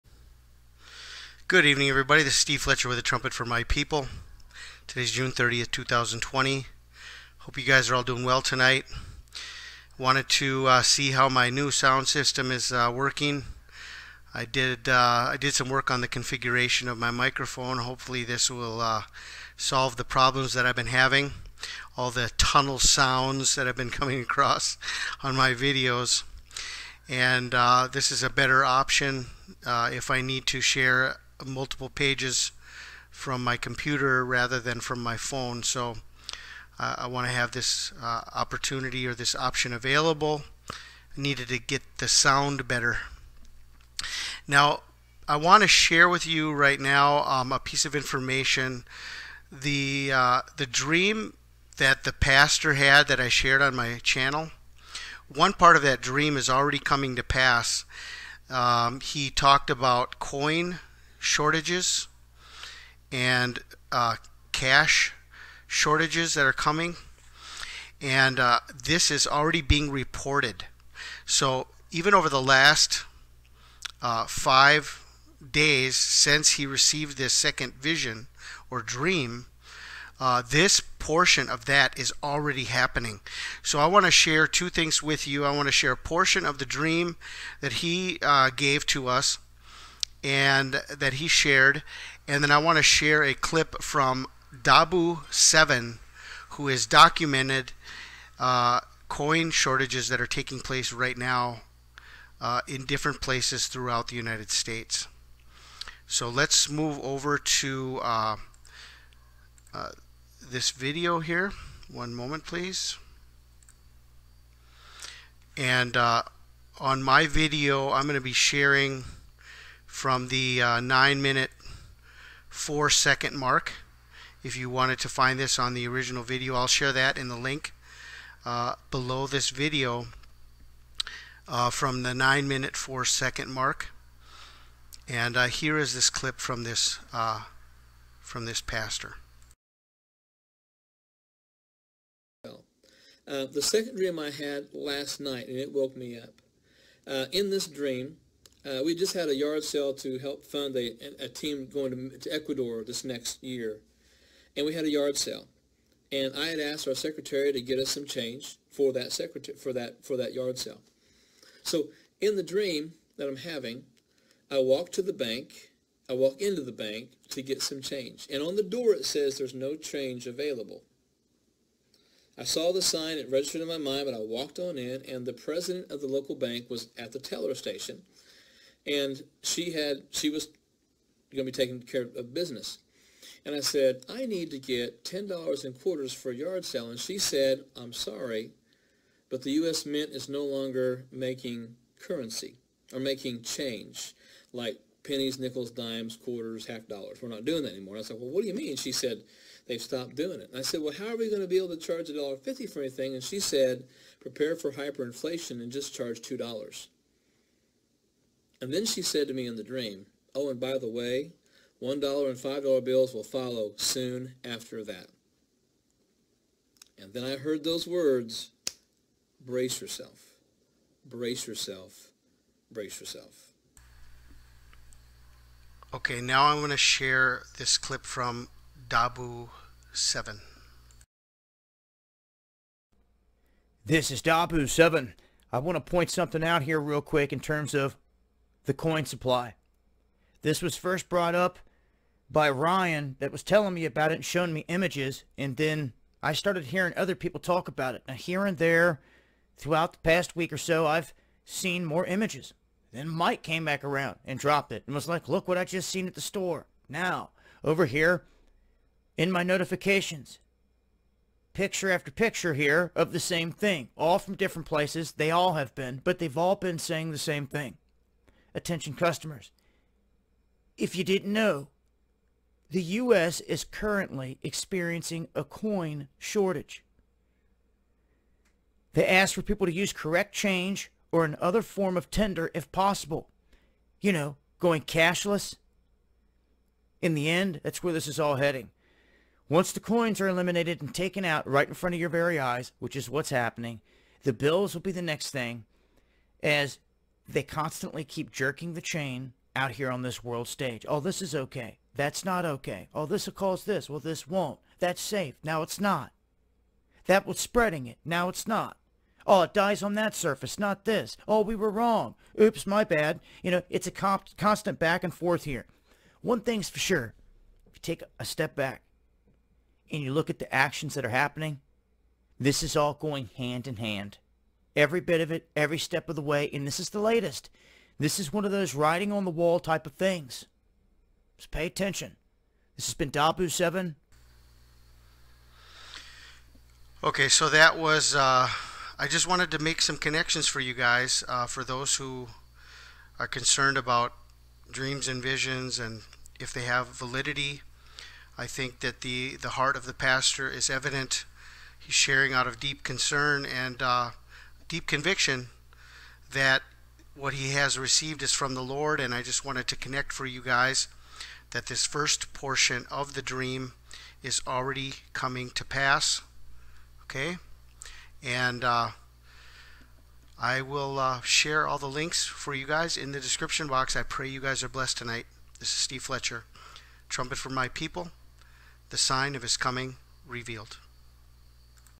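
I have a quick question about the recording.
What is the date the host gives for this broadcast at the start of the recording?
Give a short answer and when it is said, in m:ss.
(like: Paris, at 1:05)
June 30th, 2020, at 0:05.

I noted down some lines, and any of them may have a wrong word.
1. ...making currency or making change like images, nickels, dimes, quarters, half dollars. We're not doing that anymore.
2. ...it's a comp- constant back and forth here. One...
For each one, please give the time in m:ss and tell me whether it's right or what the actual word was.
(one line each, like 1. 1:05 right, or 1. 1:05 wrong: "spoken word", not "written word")
1. 3:11 wrong: "pennies", not "images"
2. 5:13 right.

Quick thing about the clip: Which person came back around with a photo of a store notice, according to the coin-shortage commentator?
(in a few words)
Mike.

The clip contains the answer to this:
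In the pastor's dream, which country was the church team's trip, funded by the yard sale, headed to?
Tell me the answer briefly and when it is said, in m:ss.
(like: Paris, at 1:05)
Ecuador, at 2:32.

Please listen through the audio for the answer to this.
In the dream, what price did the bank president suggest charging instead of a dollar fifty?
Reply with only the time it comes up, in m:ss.
3:26.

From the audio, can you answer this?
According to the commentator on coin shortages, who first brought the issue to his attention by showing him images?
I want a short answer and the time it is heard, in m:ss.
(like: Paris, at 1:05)
Ryan, at 4:02.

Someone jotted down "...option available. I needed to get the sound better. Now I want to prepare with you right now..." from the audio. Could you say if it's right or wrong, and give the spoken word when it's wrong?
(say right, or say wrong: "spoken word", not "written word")
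wrong: "share", not "prepare".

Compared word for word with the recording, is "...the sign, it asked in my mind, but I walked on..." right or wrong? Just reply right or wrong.
wrong.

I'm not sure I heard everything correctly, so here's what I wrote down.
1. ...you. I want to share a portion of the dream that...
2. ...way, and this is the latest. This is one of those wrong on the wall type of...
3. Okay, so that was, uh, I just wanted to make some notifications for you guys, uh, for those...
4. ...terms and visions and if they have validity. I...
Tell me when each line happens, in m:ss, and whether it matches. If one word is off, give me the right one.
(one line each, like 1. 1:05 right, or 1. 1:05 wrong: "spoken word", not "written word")
1. 1:25 right
2. 5:26 wrong: "writing", not "wrong"
3. 5:37 wrong: "connections", not "notifications"
4. 5:44 wrong: "dreams", not "terms".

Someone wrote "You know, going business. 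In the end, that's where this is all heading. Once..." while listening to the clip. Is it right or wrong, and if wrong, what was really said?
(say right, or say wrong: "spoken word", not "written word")
wrong: "cashless", not "business".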